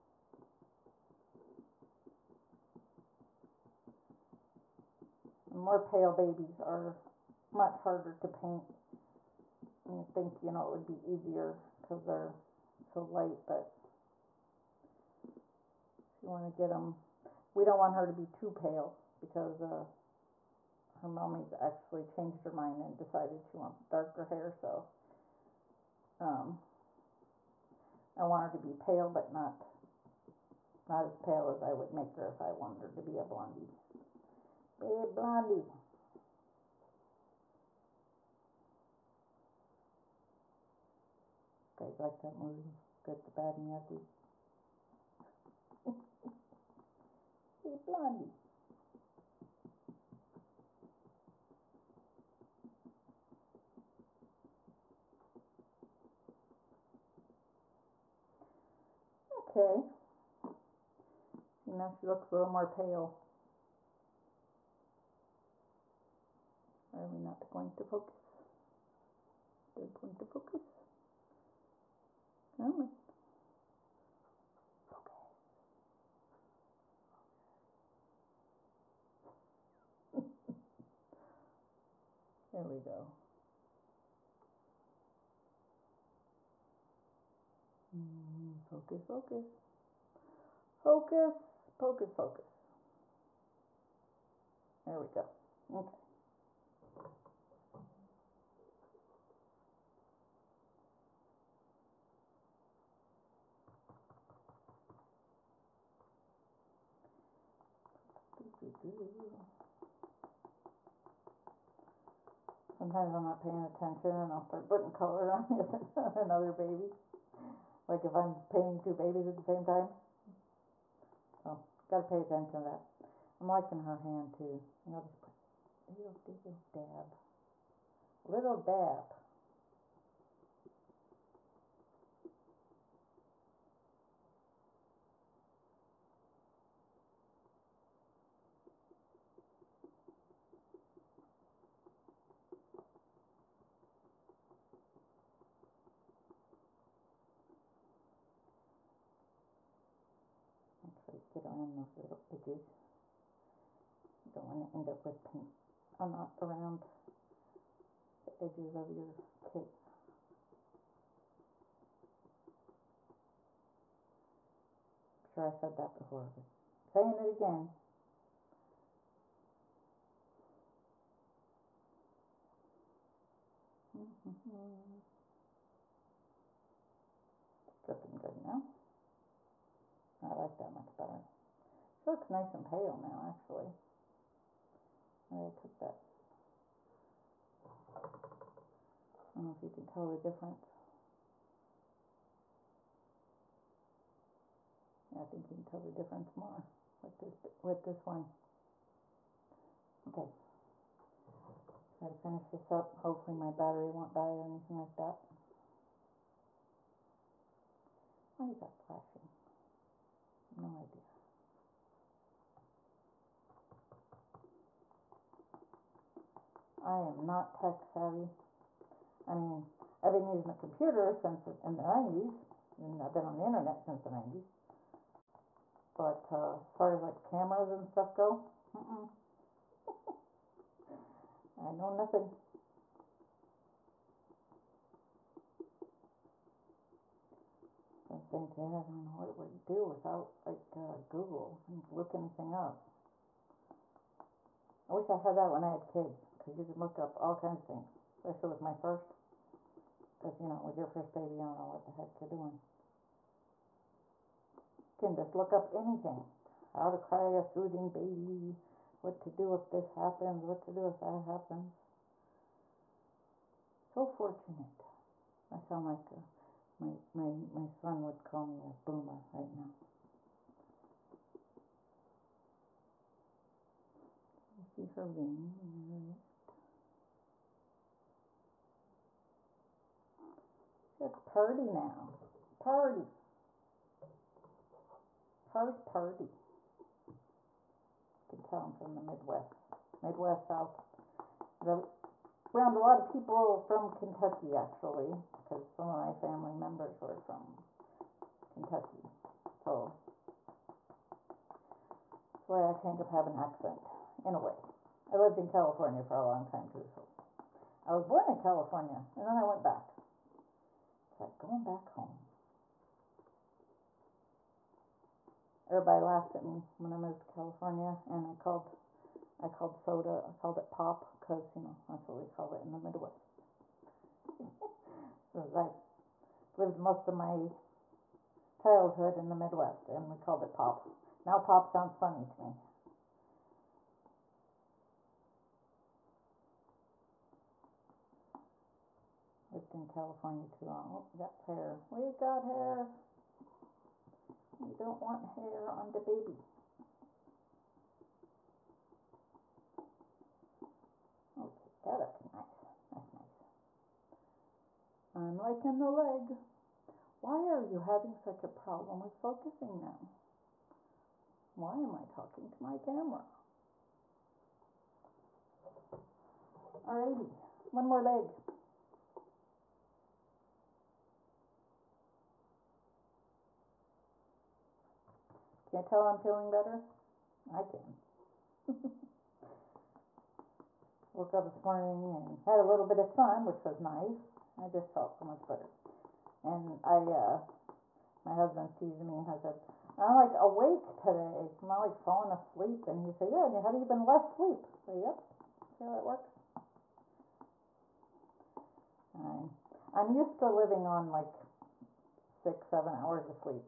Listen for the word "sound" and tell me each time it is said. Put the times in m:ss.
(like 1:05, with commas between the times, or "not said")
4:25, 5:31.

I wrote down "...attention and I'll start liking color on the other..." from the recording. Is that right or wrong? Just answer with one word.
wrong.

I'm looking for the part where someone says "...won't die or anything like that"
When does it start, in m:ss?
3:23.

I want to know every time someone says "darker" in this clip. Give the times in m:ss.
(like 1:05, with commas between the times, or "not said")
0:23.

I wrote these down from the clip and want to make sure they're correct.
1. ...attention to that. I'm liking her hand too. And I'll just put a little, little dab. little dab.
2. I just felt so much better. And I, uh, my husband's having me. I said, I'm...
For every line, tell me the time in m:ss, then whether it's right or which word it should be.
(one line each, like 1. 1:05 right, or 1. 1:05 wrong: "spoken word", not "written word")
1. 2:02 right
2. 6:24 wrong: "teasing", not "having".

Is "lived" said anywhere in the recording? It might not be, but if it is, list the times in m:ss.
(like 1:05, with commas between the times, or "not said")
5:05, 5:26.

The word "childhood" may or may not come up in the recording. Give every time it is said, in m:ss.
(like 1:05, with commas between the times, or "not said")
5:28.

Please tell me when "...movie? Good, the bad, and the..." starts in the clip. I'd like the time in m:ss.
0:42.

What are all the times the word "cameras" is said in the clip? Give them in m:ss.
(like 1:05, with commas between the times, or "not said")
3:47, 6:02.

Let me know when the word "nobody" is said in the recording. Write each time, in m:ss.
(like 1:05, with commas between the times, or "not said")
not said.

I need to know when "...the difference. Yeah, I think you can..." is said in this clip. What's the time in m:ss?
3:10.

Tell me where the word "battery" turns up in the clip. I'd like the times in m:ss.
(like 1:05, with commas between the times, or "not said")
3:23.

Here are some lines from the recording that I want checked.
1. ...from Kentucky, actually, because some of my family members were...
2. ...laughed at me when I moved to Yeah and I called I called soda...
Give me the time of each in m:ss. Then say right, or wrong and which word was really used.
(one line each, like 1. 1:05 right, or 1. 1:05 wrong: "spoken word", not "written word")
1. 4:53 right
2. 5:16 wrong: "California", not "Yeah".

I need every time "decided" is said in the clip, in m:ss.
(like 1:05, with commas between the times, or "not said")
0:22.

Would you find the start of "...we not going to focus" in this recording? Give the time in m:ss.
1:07.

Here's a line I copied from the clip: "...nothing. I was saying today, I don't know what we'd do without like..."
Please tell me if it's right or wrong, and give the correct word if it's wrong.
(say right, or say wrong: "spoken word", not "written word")
right.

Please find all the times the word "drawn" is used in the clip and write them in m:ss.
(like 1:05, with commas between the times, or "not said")
not said.